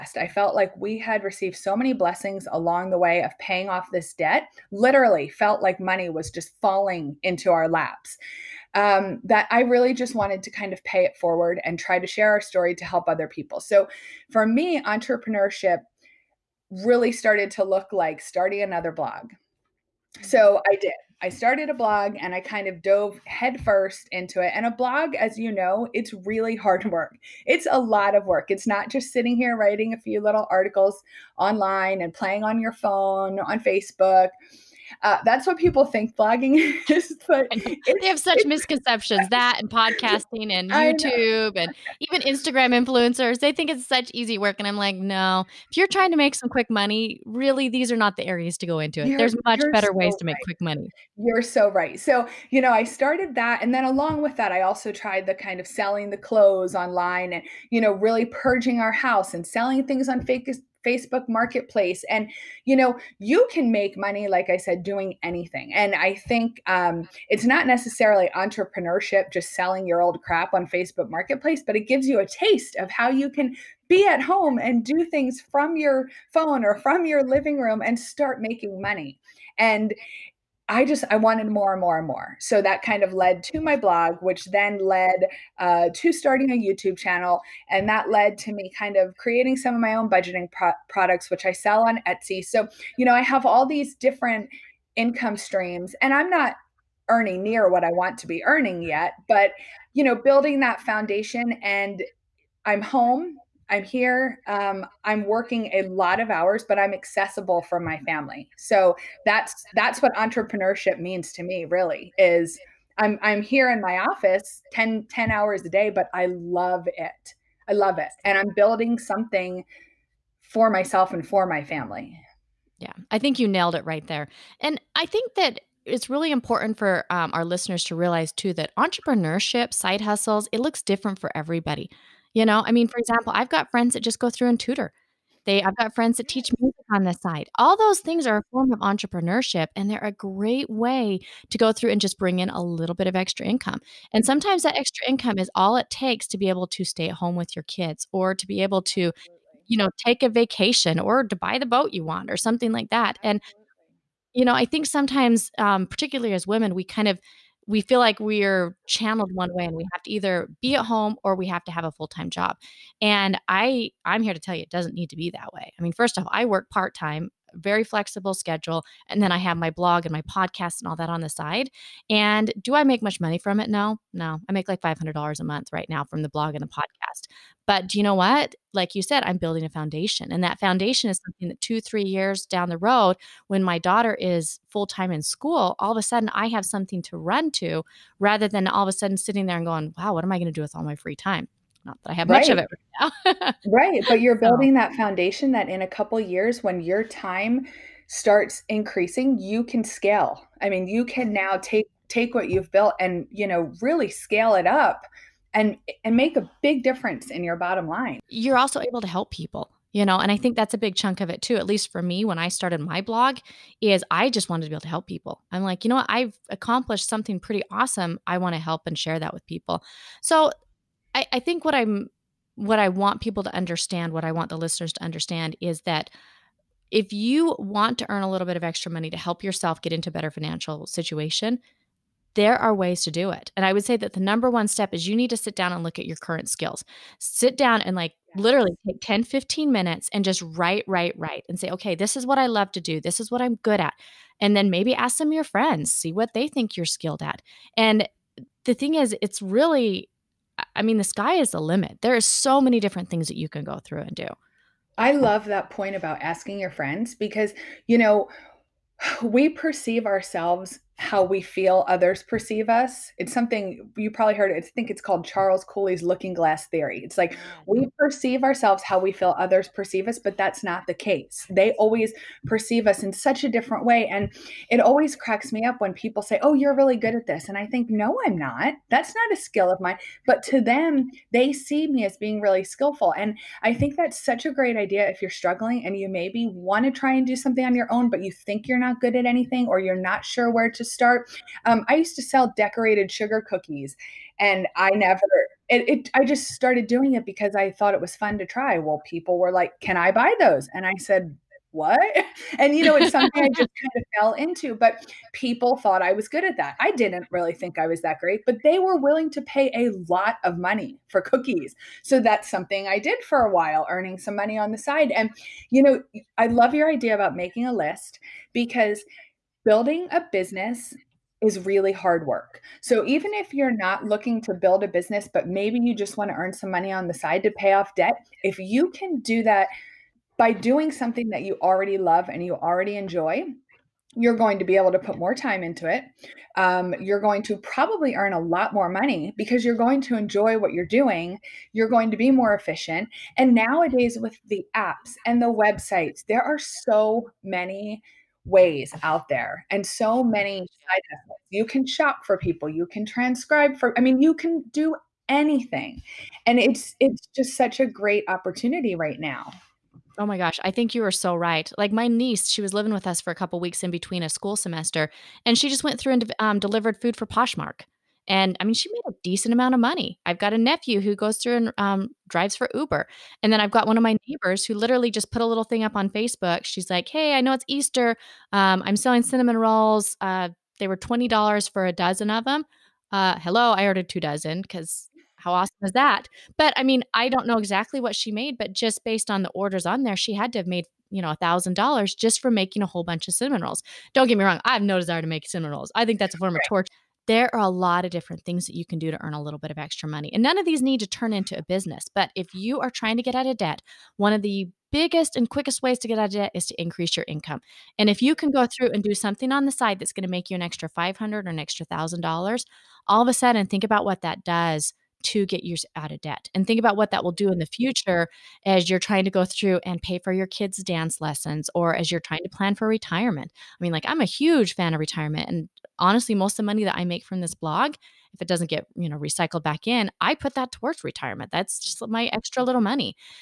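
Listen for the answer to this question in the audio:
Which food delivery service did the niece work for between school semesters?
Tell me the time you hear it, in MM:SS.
06:07.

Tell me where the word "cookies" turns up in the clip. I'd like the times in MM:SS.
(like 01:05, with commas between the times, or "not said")
04:53, 05:11.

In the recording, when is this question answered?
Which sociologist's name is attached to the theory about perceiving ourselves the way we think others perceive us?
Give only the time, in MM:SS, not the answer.
04:25.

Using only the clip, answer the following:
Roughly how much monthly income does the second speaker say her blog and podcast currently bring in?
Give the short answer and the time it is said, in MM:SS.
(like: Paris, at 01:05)
$500 a month, at 02:54.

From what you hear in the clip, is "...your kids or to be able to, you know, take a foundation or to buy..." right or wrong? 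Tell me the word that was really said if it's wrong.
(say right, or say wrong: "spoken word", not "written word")
wrong: "vacation", not "foundation".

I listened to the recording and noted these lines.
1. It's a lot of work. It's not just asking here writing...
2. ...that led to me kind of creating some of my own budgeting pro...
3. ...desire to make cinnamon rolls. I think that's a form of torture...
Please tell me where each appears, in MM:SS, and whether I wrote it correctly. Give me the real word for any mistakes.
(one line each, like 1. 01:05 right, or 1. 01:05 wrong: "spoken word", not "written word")
1. 00:27 wrong: "sitting", not "asking"
2. 01:27 right
3. 06:34 right.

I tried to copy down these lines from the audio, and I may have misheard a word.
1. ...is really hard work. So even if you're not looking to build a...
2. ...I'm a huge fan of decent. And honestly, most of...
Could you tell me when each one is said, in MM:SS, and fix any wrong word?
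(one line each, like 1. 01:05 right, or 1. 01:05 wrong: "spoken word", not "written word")
1. 05:21 right
2. 07:04 wrong: "retirement", not "decent".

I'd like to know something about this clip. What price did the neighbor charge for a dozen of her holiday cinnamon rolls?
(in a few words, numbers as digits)
$20.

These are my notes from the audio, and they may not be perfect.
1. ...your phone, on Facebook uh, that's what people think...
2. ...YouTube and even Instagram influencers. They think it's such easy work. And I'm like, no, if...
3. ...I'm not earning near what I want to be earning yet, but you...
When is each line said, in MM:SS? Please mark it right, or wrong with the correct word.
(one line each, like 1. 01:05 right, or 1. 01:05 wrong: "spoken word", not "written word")
1. 00:32 right
2. 00:40 right
3. 01:36 right.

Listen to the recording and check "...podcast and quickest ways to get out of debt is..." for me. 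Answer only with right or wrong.
wrong.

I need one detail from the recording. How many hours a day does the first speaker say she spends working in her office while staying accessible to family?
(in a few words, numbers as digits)
10.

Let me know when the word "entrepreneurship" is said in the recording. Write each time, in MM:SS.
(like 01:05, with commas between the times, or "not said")
00:14, 01:08, 01:50, 02:08, 02:18.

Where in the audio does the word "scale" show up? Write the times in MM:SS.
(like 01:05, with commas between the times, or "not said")
03:19, 03:24.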